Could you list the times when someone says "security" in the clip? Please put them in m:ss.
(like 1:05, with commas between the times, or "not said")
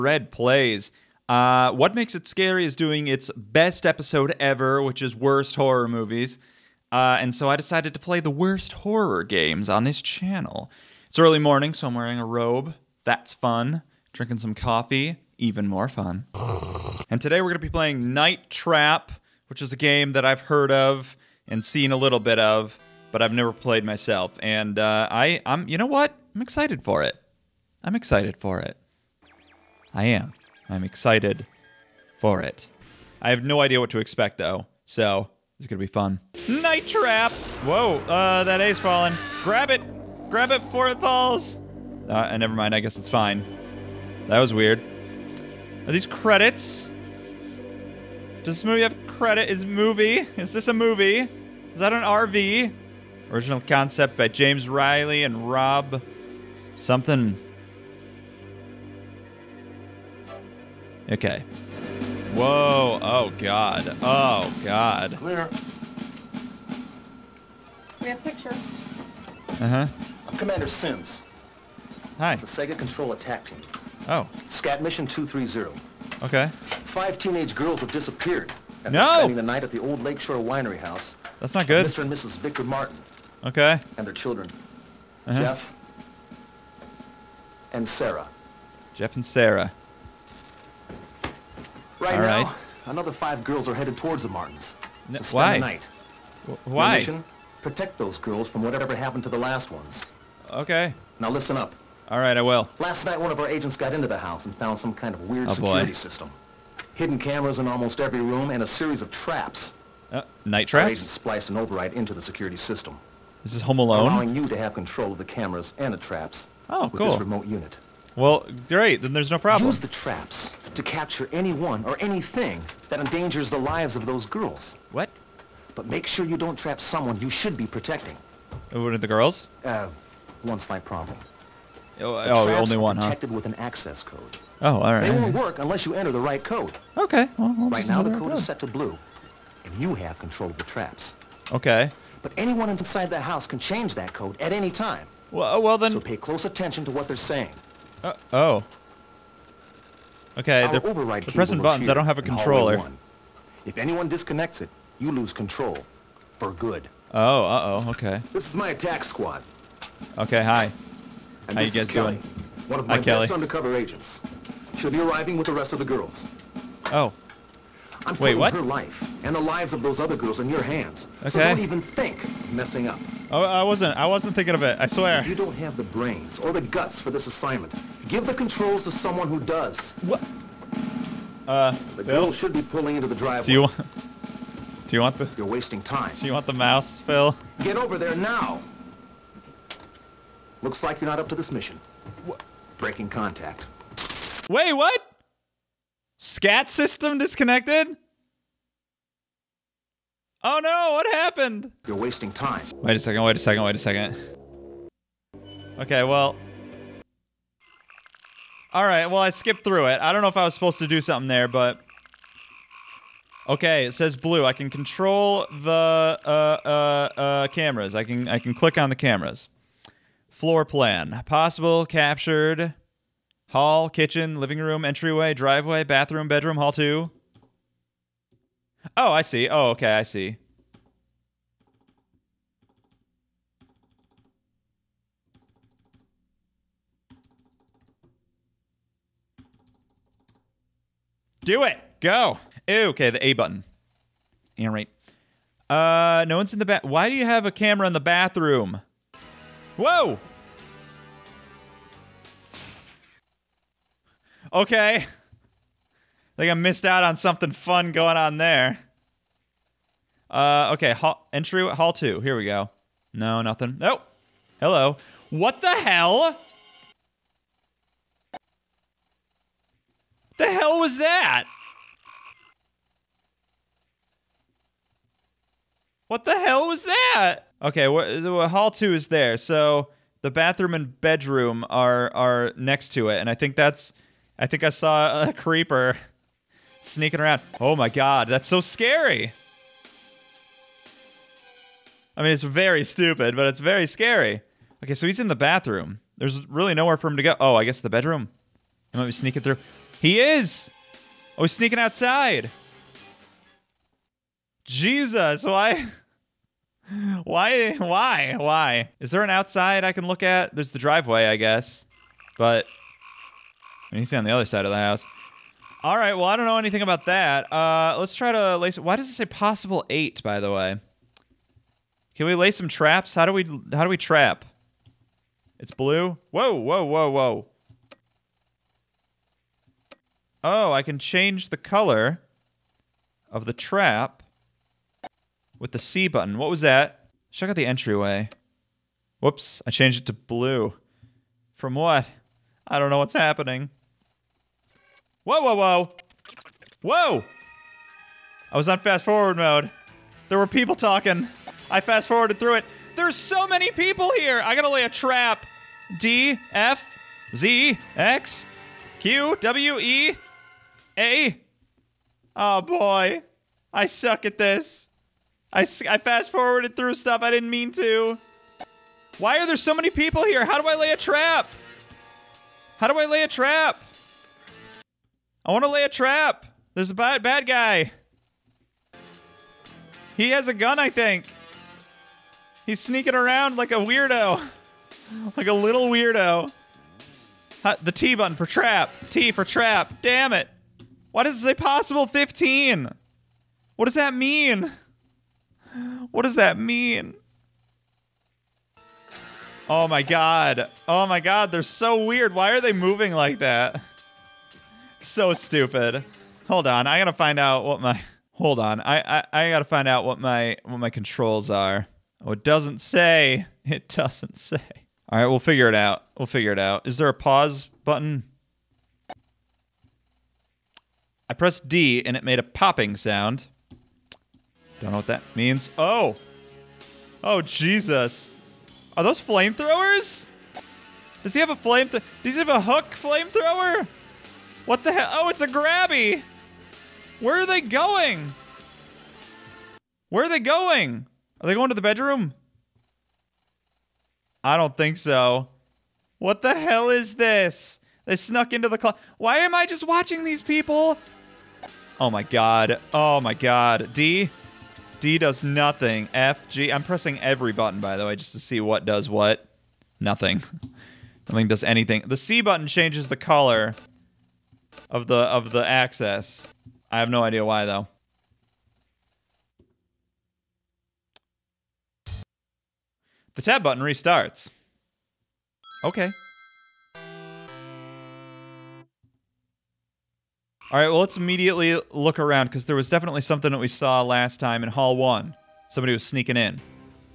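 1:45, 1:52.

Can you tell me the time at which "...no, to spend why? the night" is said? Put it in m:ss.
1:35.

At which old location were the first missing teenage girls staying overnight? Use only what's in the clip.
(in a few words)
Lakeshore Winery House.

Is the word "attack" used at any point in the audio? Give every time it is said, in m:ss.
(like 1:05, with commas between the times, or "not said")
1:13, 2:38.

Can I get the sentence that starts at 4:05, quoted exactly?
Uh, no one's in the bath.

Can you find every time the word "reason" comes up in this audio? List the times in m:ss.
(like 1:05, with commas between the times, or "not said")
not said.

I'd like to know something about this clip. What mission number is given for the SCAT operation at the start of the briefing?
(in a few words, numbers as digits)
230.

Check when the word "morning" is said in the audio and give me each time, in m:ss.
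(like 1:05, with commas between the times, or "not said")
0:11.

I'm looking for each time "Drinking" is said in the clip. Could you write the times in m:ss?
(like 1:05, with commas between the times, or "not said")
0:14.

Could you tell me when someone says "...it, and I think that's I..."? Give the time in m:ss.
4:43.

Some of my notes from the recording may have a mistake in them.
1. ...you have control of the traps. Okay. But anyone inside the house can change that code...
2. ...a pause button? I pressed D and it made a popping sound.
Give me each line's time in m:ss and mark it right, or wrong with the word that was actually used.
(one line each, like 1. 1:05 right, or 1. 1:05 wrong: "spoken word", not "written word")
1. 2:19 right
2. 6:57 right.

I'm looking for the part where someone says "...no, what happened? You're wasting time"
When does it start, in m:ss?
3:20.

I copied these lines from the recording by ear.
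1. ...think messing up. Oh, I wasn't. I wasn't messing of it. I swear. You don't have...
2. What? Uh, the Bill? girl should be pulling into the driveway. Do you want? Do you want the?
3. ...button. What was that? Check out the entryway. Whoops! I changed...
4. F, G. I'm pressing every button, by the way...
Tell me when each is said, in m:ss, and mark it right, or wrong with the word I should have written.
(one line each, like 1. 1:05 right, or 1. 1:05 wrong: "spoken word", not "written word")
1. 2:51 wrong: "thinking", not "messing"
2. 3:00 right
3. 5:36 right
4. 7:36 right.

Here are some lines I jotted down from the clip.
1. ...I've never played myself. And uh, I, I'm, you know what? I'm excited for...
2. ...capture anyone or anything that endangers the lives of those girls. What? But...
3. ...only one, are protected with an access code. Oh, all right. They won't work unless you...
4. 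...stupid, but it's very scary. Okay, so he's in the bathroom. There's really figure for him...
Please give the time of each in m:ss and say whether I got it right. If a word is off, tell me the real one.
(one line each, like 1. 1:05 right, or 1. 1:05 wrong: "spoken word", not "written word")
1. 0:23 right
2. 2:00 right
3. 2:12 right
4. 4:52 wrong: "nowhere", not "figure".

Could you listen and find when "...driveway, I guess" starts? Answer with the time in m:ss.
5:10.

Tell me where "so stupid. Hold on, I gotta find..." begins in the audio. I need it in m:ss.
6:44.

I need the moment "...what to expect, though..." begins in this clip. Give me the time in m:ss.
0:33.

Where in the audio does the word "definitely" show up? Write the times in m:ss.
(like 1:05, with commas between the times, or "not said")
8:02.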